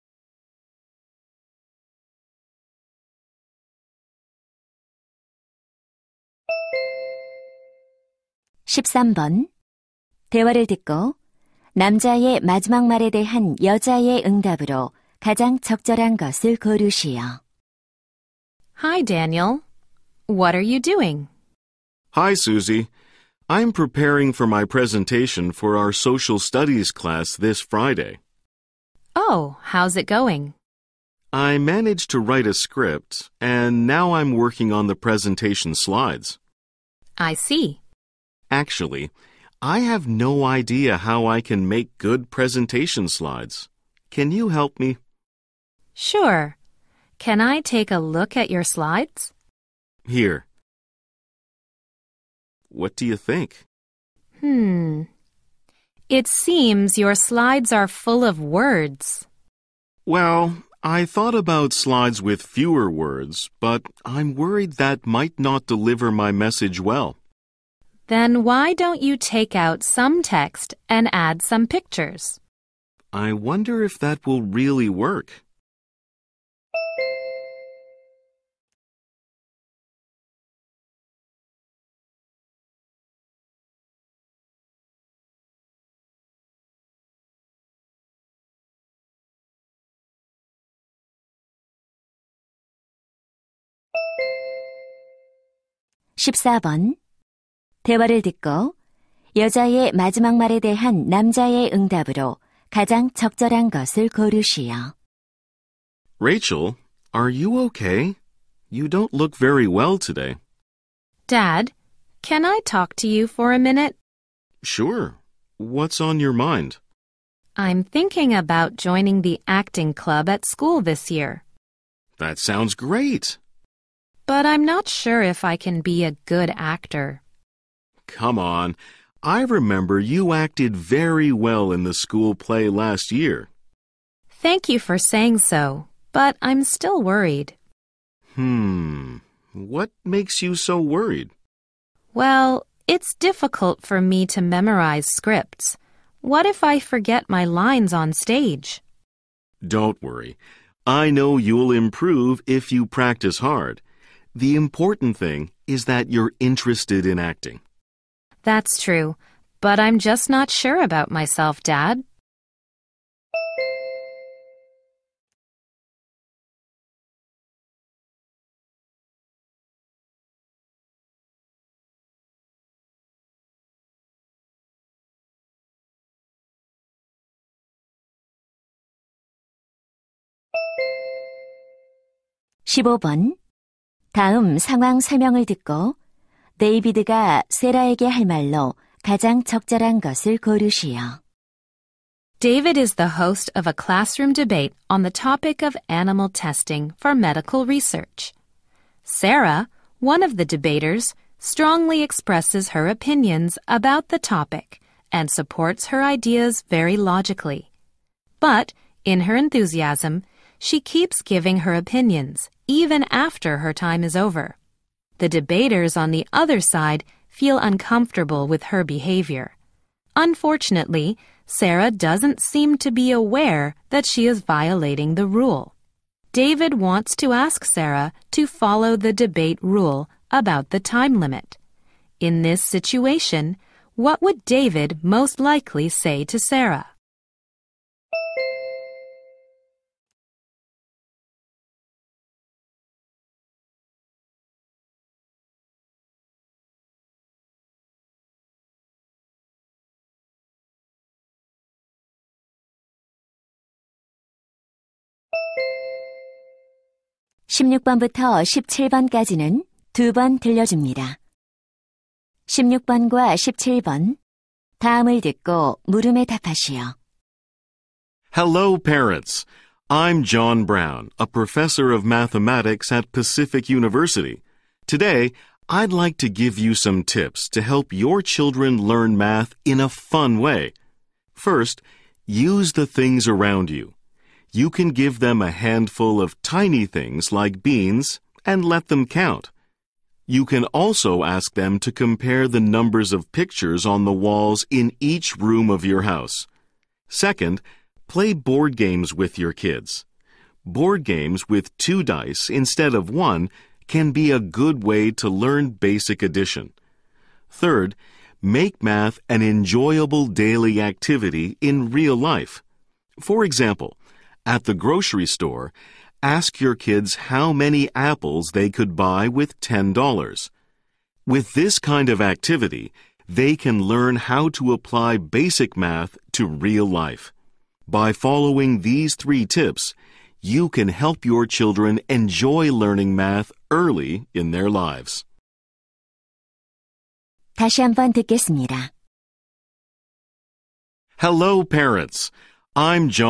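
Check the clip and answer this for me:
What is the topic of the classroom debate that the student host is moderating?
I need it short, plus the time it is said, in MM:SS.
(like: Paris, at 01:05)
animal testing for medical research, at 03:15.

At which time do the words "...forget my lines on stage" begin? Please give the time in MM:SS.
02:26.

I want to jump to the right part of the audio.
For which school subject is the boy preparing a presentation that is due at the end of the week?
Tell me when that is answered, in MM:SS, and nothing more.
00:25.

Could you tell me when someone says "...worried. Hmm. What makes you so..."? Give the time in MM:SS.
02:17.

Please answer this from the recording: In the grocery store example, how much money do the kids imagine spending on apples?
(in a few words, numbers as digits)
$10.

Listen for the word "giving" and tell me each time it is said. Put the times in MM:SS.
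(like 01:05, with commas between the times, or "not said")
03:31.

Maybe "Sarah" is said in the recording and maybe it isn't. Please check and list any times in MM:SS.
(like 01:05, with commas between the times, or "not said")
03:19, 03:41, 03:47, 03:56.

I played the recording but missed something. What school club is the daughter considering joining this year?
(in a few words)
acting club.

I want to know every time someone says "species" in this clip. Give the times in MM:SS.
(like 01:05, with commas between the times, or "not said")
not said.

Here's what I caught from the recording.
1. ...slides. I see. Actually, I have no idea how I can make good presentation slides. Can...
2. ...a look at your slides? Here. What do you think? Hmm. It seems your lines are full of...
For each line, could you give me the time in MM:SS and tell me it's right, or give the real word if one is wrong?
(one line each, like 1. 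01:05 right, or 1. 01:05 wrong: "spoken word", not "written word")
1. 00:35 right
2. 00:47 wrong: "slides", not "lines".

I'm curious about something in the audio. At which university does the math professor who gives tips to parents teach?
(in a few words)
Pacific University.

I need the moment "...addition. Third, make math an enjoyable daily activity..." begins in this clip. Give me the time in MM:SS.
05:06.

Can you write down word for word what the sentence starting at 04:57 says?
Second, play board games with your kids.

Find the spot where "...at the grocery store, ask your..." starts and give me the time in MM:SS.
05:14.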